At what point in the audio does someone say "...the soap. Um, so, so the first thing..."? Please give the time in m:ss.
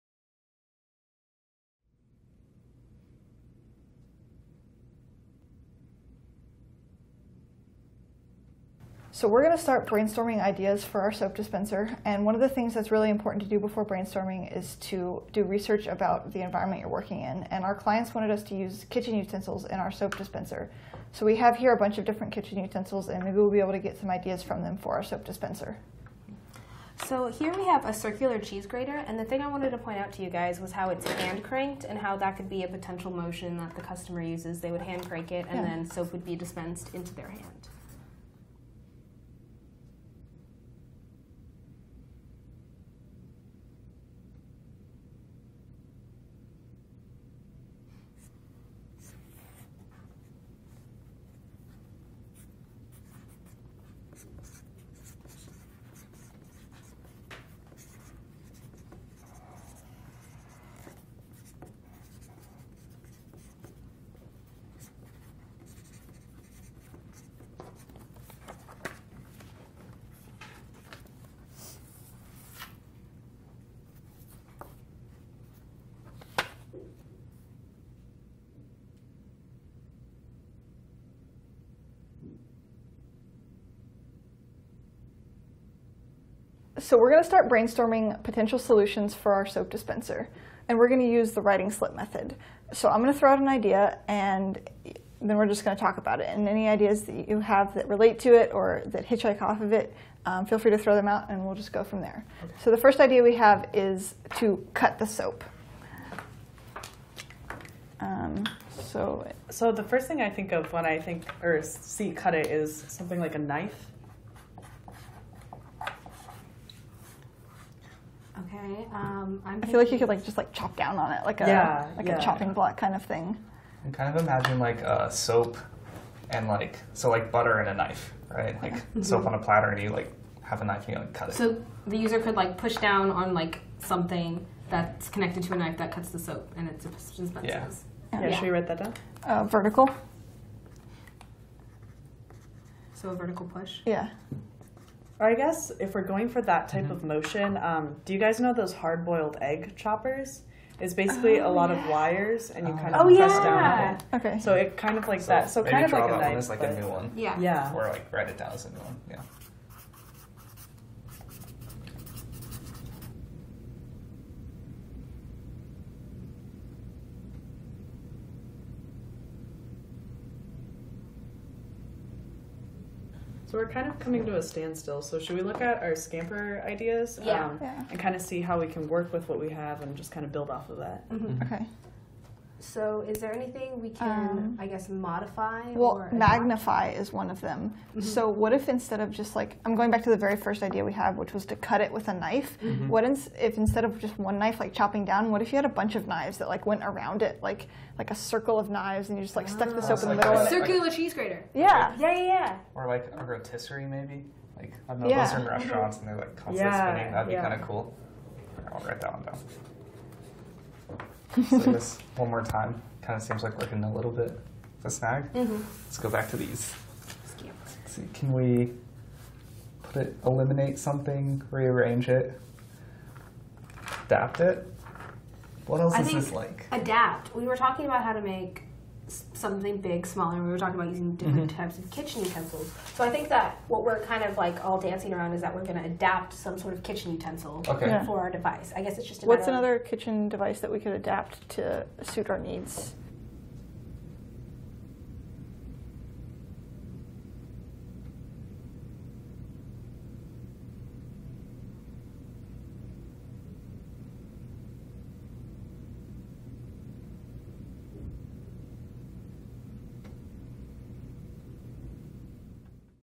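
1:44.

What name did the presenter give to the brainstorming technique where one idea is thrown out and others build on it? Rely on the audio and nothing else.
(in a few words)
writing slip method.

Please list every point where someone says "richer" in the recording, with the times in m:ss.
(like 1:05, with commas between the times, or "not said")
not said.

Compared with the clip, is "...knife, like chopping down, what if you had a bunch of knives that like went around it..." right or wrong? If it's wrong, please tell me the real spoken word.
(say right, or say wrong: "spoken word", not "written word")
right.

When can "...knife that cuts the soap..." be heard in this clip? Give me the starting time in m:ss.
2:15.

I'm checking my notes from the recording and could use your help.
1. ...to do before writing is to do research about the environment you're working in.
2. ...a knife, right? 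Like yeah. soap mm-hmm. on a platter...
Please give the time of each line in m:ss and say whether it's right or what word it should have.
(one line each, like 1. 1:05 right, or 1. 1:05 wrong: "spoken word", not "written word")
1. 0:13 wrong: "brainstorming", not "writing"
2. 2:07 right.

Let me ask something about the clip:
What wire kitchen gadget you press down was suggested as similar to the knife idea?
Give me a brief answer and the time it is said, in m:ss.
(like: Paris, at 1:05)
hard boiled egg choppers, at 2:28.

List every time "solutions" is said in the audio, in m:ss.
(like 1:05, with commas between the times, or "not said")
1:28.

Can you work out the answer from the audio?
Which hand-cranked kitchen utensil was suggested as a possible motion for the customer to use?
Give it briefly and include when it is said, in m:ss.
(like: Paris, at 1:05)
circular cheese grater, at 0:27.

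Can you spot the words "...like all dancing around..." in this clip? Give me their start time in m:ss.
3:54.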